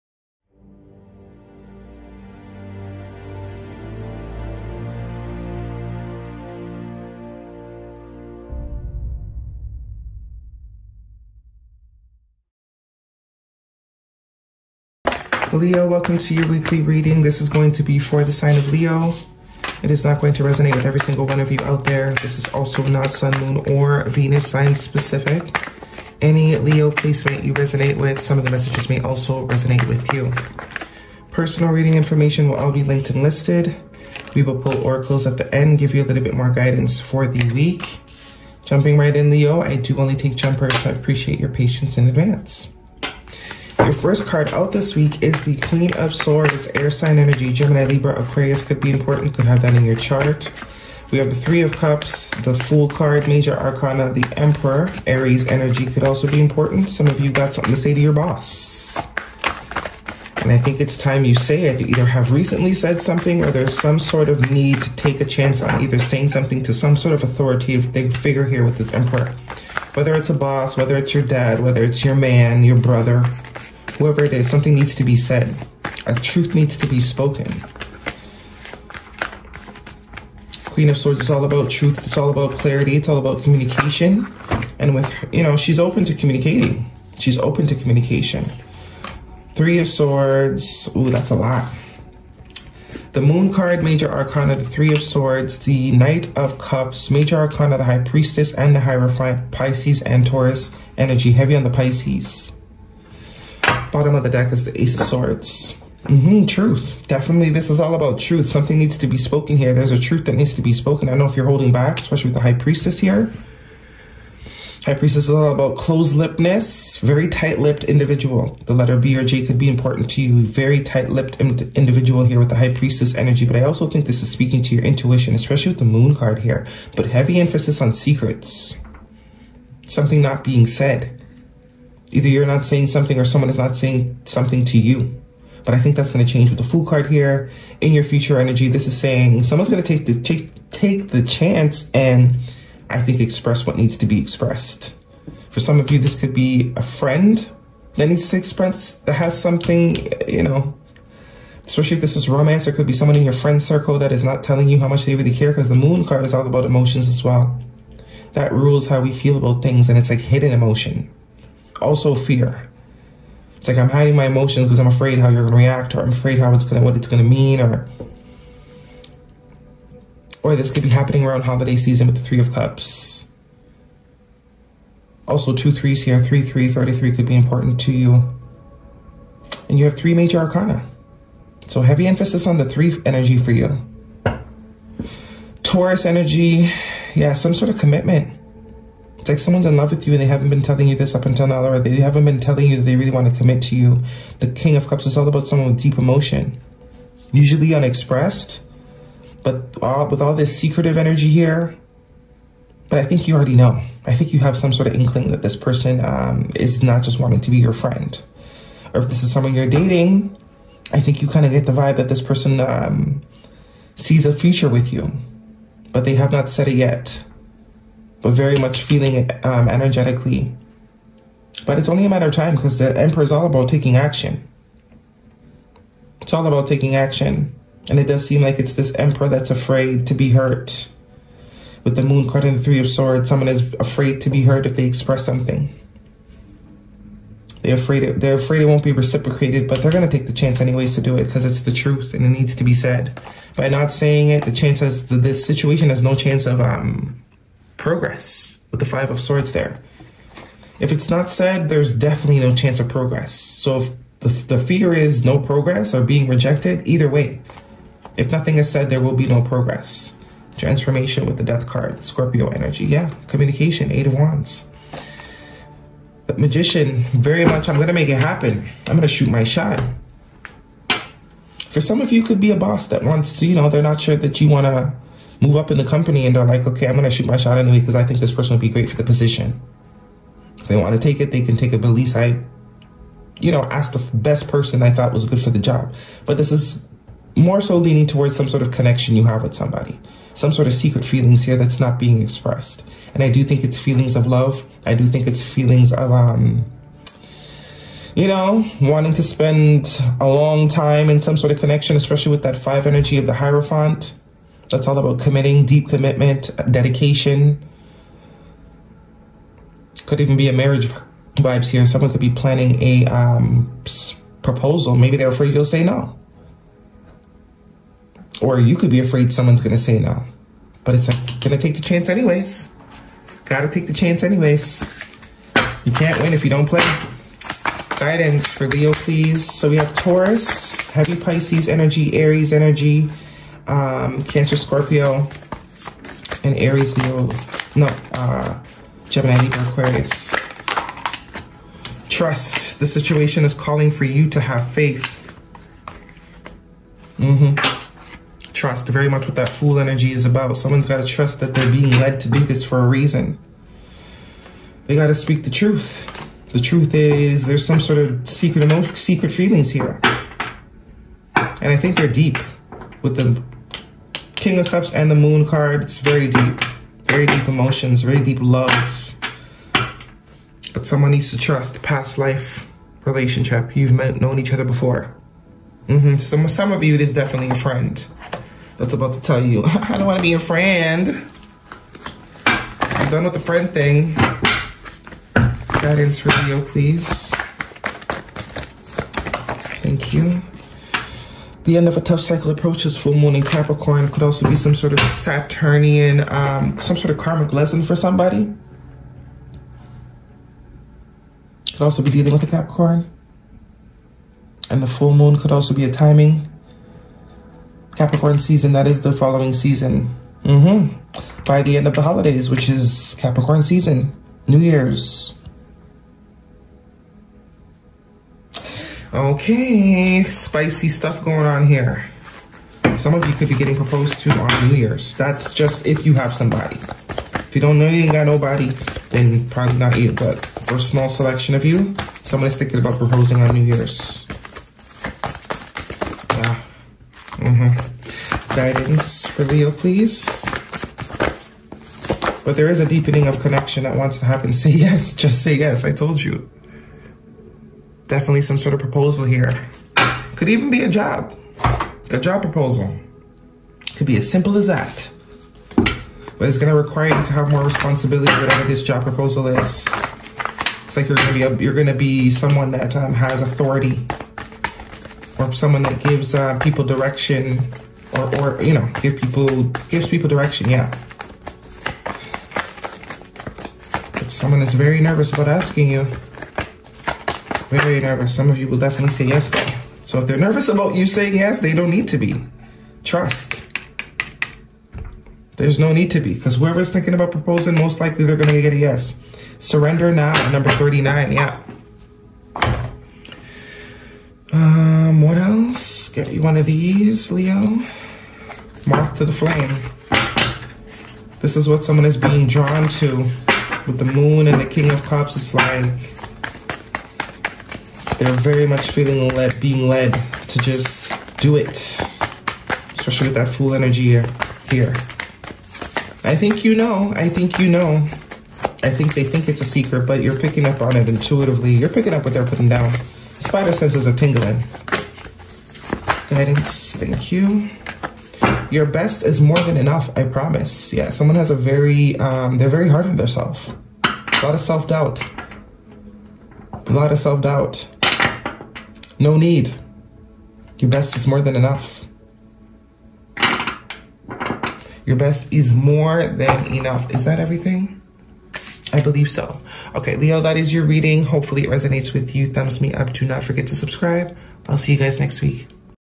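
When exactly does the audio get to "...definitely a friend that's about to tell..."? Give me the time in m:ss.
6:17.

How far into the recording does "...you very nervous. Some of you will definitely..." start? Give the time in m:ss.
7:55.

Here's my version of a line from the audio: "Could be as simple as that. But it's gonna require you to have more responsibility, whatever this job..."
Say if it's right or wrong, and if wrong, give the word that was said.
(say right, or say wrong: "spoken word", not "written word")
right.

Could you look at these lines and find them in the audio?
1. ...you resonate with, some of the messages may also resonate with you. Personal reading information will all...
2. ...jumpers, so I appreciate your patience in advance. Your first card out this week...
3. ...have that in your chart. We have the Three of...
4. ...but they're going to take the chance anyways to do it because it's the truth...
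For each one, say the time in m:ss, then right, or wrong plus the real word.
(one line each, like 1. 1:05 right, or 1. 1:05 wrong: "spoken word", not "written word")
1. 0:27 right
2. 0:40 right
3. 0:49 right
4. 3:59 right.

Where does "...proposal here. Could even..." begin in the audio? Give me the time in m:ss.
7:28.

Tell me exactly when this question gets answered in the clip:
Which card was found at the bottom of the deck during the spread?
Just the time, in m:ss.
1:44.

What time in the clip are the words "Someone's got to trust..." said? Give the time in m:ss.
5:50.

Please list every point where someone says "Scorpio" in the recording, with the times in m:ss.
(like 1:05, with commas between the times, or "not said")
4:22, 5:34.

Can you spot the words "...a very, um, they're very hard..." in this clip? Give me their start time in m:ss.
8:51.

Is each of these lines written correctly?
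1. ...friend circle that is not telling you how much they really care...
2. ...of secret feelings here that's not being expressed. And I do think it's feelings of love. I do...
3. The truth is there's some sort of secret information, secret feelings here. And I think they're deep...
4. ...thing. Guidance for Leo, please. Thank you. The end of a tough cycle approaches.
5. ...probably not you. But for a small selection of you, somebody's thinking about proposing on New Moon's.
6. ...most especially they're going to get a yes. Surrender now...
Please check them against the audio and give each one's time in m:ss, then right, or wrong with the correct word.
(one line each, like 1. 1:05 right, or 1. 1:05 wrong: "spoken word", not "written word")
1. 2:33 right
2. 4:50 right
3. 5:56 wrong: "emotion", not "information"
4. 6:23 right
5. 7:09 wrong: "Year", not "Moon"
6. 8:07 wrong: "likely", not "especially".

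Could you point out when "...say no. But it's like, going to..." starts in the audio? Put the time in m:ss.
5:19.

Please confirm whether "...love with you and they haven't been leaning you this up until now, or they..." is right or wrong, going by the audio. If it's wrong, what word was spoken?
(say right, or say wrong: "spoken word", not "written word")
wrong: "telling", not "leaning".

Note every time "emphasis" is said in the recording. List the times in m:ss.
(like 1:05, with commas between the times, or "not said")
2:07, 3:02.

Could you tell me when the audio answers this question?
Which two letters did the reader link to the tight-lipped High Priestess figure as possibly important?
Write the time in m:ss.
1:58.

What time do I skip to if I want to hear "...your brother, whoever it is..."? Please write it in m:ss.
1:12.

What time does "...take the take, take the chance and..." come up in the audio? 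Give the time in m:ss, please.
2:19.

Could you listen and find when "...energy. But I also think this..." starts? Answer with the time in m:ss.
2:03.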